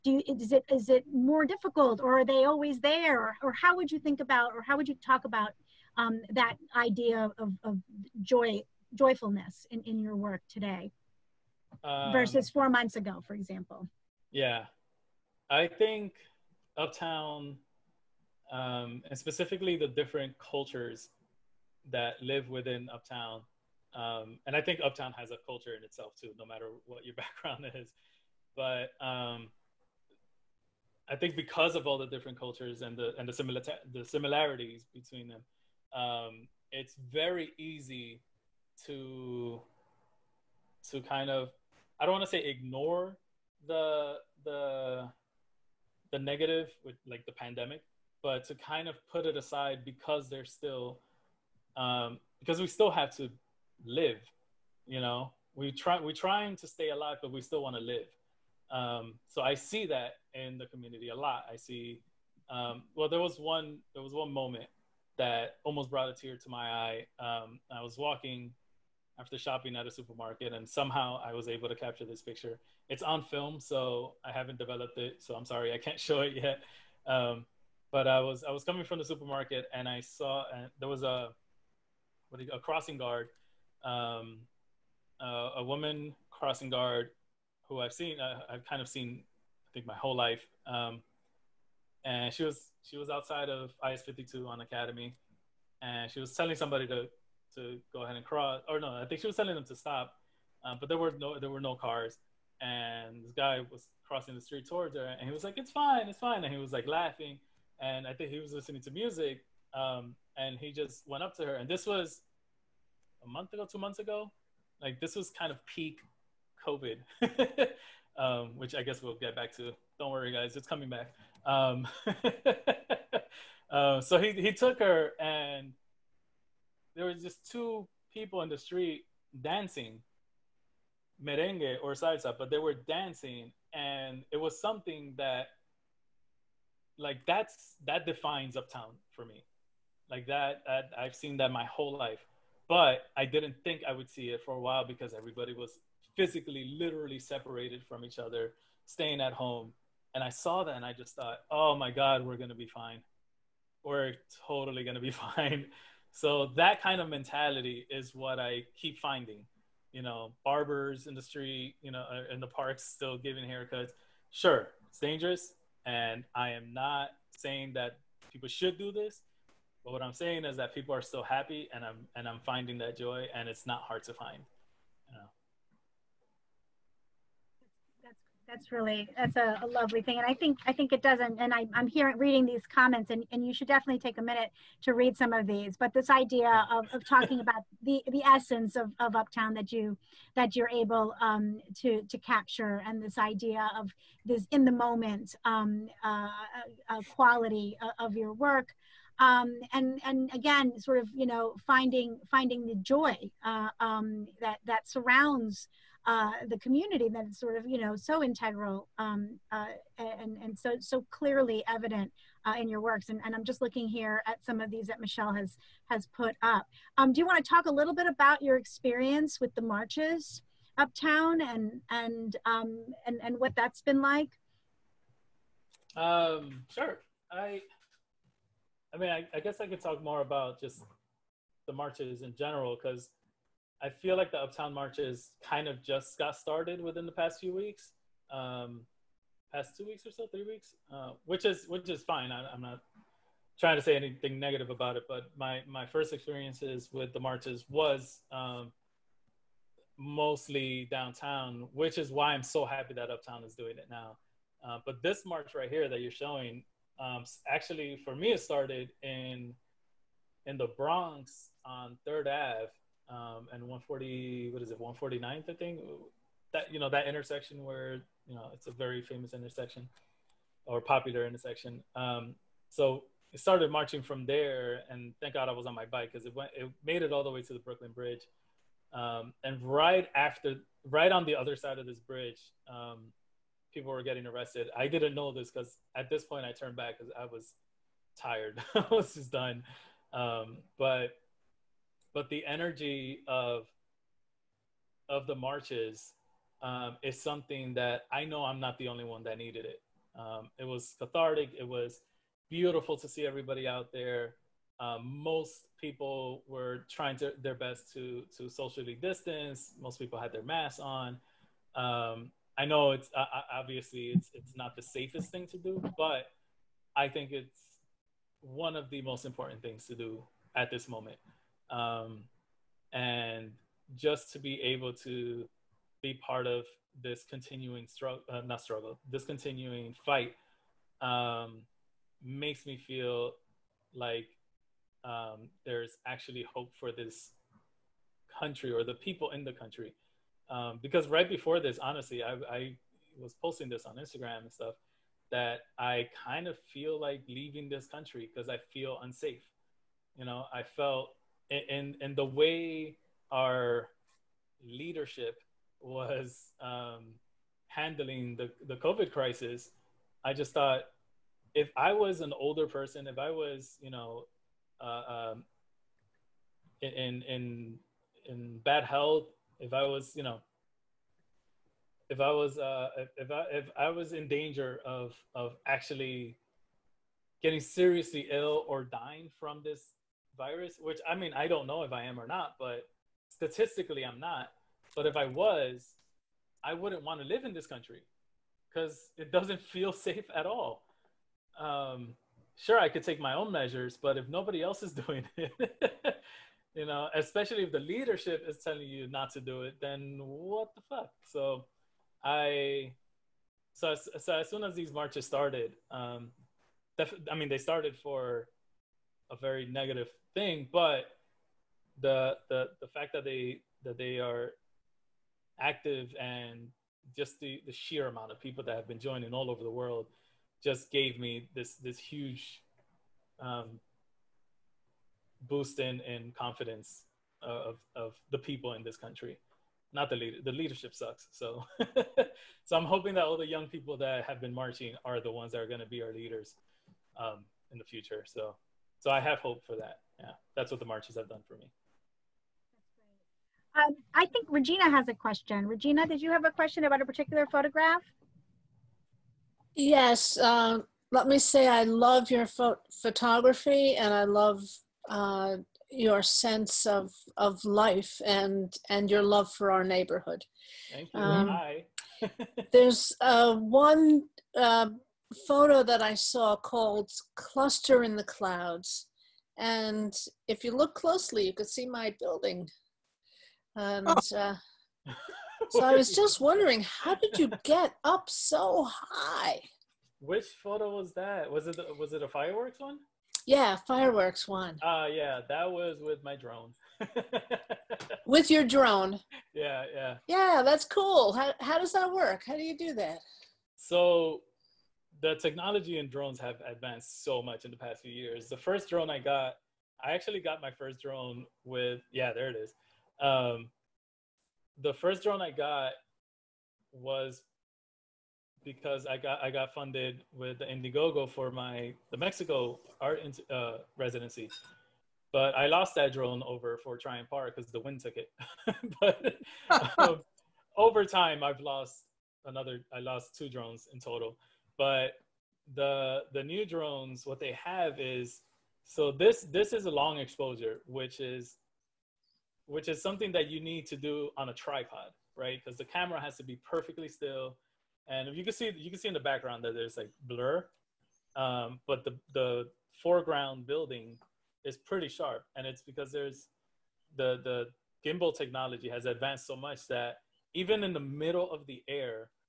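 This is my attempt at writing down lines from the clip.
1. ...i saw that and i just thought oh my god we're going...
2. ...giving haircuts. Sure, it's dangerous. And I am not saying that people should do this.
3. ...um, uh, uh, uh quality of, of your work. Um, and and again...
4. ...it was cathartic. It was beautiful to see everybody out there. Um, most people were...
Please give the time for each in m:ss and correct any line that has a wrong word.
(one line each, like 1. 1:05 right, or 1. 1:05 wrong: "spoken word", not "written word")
1. 2:30 right
2. 2:43 right
3. 3:15 right
4. 5:00 right.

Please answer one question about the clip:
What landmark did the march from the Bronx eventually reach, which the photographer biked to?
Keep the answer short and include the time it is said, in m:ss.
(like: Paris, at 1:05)
Brooklyn Bridge, at 4:37.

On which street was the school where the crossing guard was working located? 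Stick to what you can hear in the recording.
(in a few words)
Academy.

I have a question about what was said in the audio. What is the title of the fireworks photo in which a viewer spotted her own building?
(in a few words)
Cluster in the Clouds.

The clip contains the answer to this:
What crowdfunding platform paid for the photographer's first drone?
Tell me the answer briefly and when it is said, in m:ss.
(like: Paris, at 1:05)
Indiegogo, at 8:30.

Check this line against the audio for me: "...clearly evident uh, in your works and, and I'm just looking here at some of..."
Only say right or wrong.
right.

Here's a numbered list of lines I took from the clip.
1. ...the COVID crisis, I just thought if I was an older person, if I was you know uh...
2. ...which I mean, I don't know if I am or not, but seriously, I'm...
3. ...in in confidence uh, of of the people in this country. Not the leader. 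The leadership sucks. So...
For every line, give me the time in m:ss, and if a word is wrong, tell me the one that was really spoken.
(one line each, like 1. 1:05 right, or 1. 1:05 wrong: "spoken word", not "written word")
1. 5:58 right
2. 6:20 wrong: "statistically", not "seriously"
3. 7:05 right.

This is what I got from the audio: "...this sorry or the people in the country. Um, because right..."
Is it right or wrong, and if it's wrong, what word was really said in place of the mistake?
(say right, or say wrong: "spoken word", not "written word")
wrong: "country", not "sorry".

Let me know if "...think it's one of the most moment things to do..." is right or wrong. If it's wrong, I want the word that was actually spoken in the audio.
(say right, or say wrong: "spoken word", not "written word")
wrong: "important", not "moment".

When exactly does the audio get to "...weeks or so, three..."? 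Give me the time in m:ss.
3:59.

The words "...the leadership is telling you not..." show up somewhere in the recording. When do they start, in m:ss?
6:37.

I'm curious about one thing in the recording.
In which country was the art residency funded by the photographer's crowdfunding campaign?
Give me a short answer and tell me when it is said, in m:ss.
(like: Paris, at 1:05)
Mexico, at 8:32.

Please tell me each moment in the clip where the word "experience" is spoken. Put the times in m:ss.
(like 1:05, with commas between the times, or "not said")
3:38, 4:06.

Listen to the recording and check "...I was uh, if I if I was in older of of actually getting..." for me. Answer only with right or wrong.
wrong.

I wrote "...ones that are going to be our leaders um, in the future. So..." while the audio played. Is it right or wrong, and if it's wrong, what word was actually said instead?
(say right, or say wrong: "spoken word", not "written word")
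right.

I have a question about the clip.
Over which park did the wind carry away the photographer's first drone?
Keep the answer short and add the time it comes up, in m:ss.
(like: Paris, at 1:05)
Fort Tryon Park, at 8:36.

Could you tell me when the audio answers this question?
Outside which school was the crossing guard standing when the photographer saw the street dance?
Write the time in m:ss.
1:33.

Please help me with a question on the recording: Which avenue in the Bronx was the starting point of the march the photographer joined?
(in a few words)
Third Ave.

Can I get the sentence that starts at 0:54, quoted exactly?
You know, we try we're trying to stay alive, but we still want to live.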